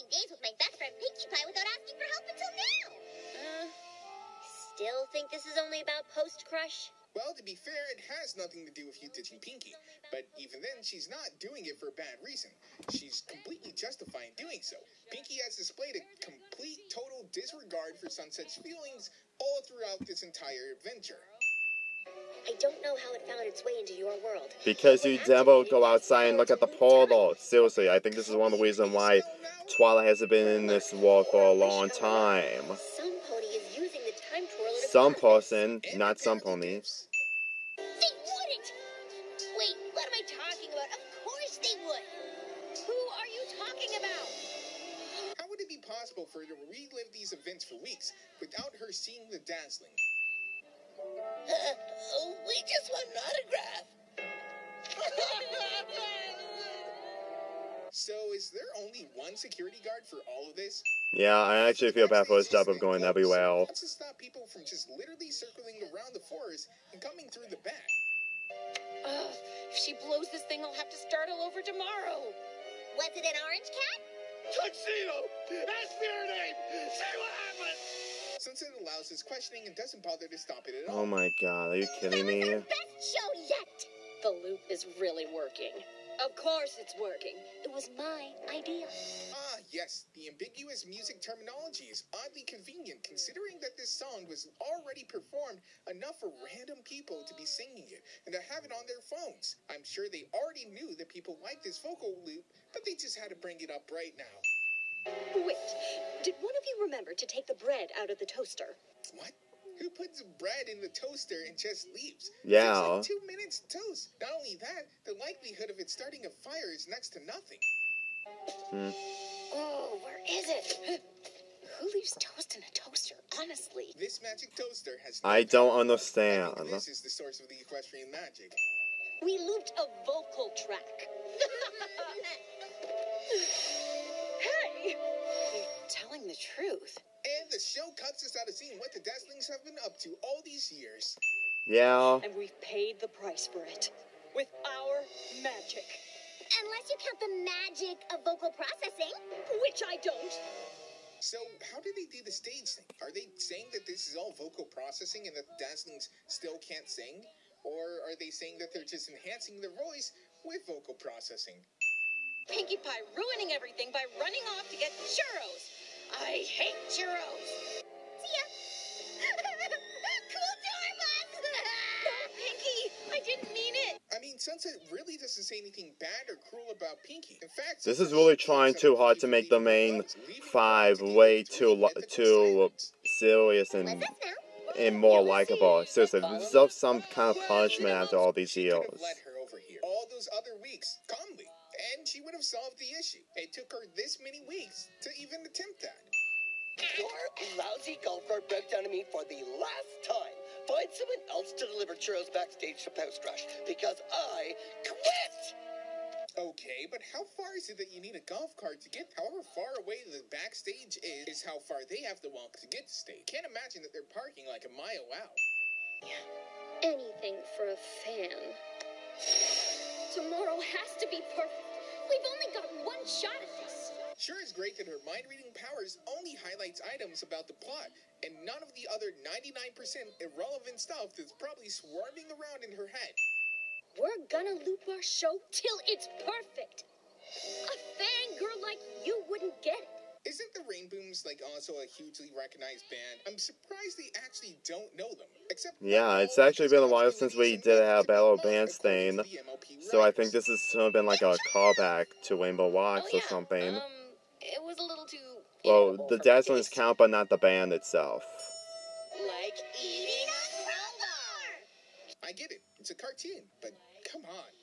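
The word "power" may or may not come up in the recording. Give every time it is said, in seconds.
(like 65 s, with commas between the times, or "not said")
125 s, 225 s.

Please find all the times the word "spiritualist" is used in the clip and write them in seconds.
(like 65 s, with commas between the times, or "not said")
not said.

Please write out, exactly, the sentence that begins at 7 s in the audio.
Well, to be fair, it has nothing to do with you ditching Pinkie.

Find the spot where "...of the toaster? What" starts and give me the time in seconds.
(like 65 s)
108 s.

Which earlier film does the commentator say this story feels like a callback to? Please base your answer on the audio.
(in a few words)
Rainbow Rocks.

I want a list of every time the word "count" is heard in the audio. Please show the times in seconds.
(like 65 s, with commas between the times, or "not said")
147 s, 256 s.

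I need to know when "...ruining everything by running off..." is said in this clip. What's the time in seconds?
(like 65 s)
163 s.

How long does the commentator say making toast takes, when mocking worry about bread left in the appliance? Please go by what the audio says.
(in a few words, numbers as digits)
2 minutes.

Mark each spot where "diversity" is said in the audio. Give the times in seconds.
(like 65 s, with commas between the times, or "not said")
not said.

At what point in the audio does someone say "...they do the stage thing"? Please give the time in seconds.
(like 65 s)
151 s.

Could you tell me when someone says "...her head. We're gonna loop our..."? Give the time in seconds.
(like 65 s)
232 s.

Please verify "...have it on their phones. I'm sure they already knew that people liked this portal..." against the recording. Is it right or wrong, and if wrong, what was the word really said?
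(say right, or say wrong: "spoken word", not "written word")
wrong: "vocal", not "portal".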